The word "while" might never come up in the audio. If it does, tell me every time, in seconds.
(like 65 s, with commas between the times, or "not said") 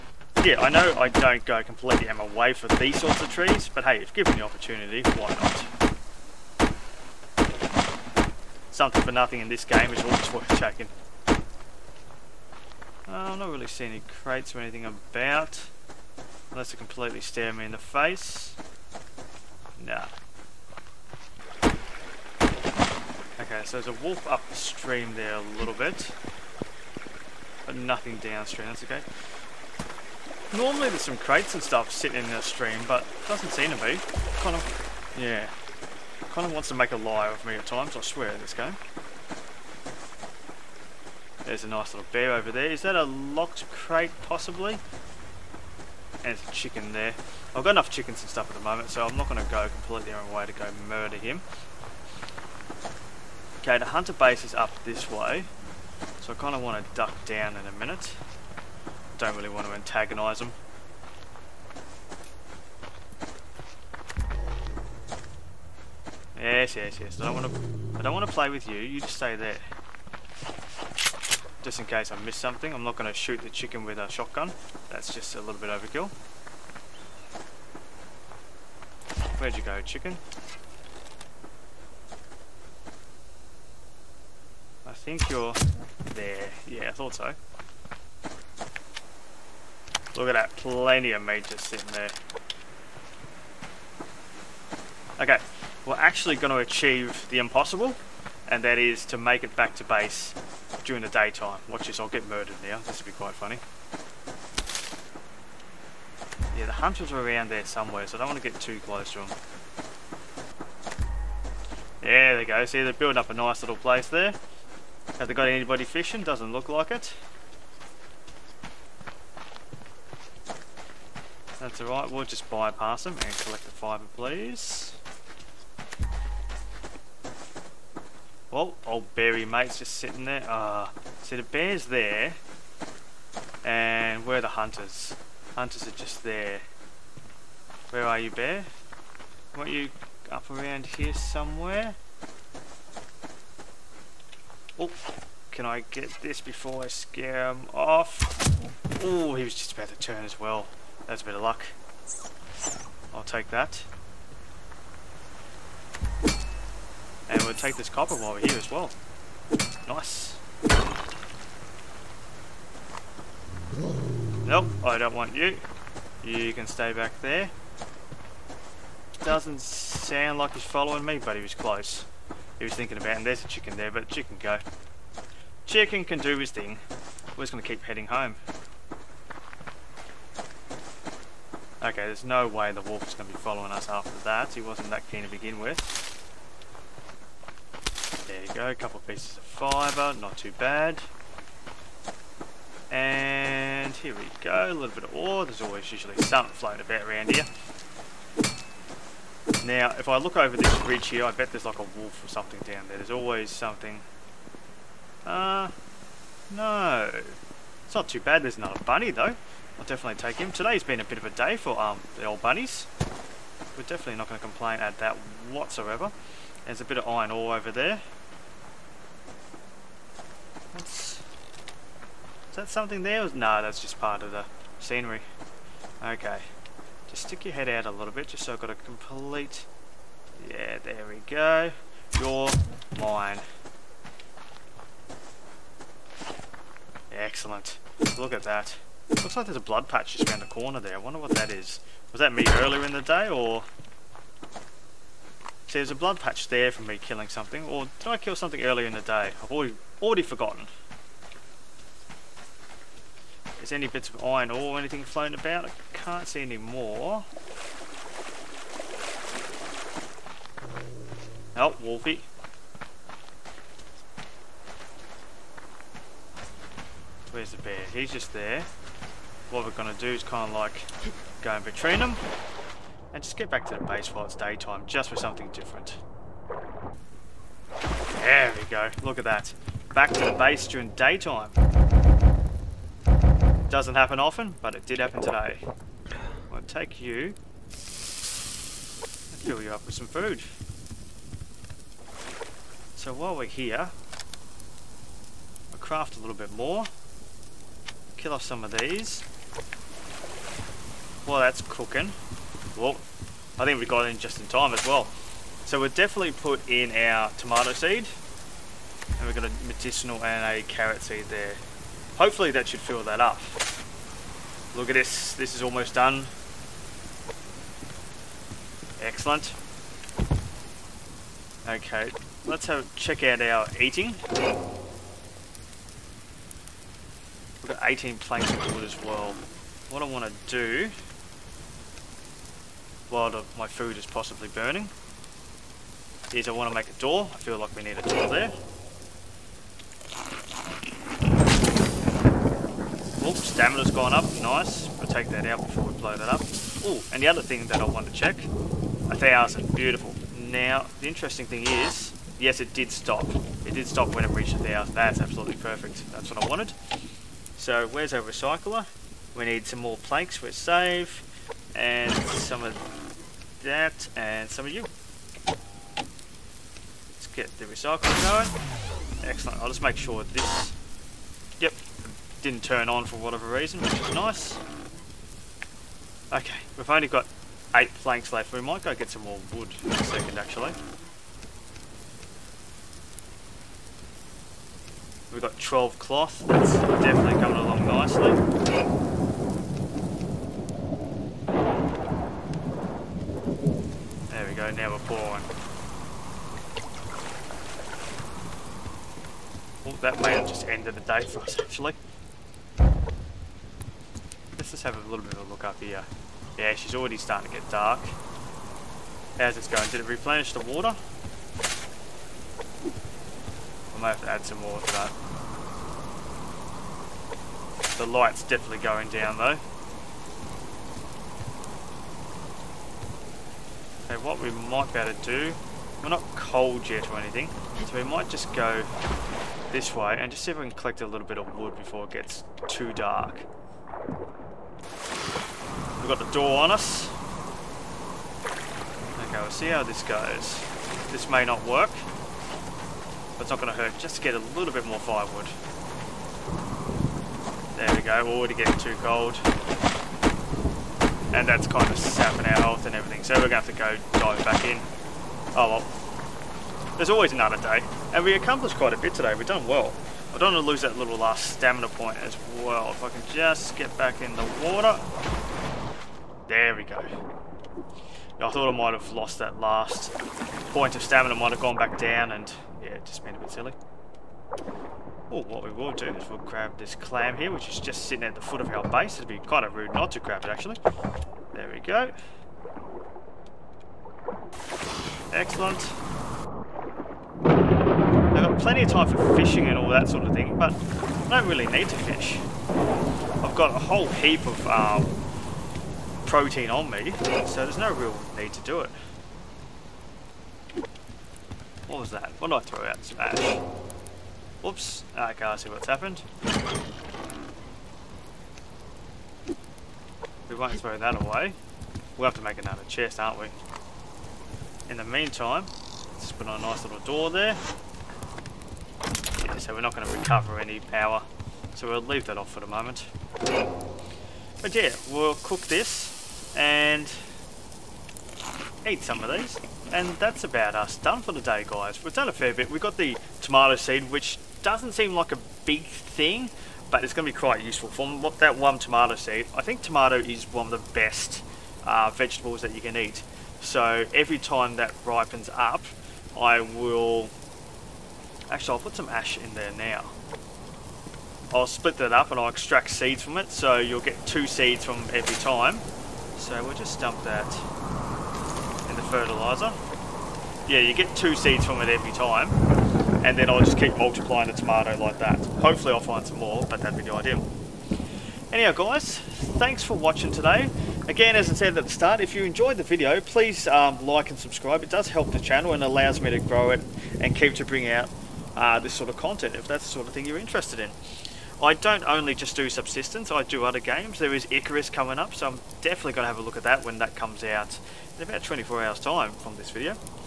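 158 s, 274 s, 293 s, 333 s.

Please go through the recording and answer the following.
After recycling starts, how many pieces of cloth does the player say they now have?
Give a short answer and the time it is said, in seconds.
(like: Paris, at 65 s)
12, at 385 s.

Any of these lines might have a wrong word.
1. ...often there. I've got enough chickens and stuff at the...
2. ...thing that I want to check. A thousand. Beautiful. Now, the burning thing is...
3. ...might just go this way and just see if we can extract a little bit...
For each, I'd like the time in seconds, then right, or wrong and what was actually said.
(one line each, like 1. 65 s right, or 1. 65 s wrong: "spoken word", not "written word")
1. 46 s wrong: "chicken", not "often"
2. 347 s wrong: "interesting", not "burning"
3. 428 s wrong: "collect", not "extract".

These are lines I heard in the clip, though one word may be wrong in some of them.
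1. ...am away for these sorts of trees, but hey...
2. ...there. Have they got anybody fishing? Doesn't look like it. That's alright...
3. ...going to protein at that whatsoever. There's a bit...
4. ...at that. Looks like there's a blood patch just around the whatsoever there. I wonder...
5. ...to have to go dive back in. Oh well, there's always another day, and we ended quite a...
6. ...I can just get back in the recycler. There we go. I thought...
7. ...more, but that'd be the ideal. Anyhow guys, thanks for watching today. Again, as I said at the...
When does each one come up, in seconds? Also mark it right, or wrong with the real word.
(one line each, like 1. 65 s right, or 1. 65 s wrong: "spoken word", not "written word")
1. 2 s right
2. 114 s right
3. 214 s wrong: "complain", not "protein"
4. 238 s wrong: "corner", not "whatsoever"
5. 453 s wrong: "accomplished", not "ended"
6. 463 s wrong: "water", not "recycler"
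7. 566 s right.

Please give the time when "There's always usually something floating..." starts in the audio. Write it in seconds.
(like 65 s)
195 s.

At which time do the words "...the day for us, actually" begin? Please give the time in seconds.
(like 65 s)
400 s.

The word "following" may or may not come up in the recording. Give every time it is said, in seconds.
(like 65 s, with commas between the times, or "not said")
170 s, 183 s.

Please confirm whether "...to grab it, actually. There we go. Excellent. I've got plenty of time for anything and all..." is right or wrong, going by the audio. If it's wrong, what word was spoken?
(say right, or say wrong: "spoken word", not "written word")
wrong: "fishing", not "anything".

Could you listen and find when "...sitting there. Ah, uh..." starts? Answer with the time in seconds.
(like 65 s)
129 s.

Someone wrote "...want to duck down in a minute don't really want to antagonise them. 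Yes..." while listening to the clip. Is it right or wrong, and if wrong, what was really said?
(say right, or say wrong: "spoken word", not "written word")
right.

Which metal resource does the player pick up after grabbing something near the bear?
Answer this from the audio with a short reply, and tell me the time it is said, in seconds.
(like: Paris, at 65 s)
Copper, at 157 s.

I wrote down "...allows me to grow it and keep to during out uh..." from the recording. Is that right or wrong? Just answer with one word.
wrong.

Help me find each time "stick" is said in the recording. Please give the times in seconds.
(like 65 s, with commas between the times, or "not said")
227 s.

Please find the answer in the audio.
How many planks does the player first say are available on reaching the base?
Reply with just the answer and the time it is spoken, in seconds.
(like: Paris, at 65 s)
18, at 327 s.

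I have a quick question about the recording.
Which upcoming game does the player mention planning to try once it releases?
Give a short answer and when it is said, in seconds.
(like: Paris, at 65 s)
Icarus, at 584 s.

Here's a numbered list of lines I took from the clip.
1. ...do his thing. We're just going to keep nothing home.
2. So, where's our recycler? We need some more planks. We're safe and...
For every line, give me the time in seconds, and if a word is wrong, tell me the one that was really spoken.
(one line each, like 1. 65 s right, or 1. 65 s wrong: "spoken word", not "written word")
1. 176 s wrong: "heading", not "nothing"
2. 357 s right.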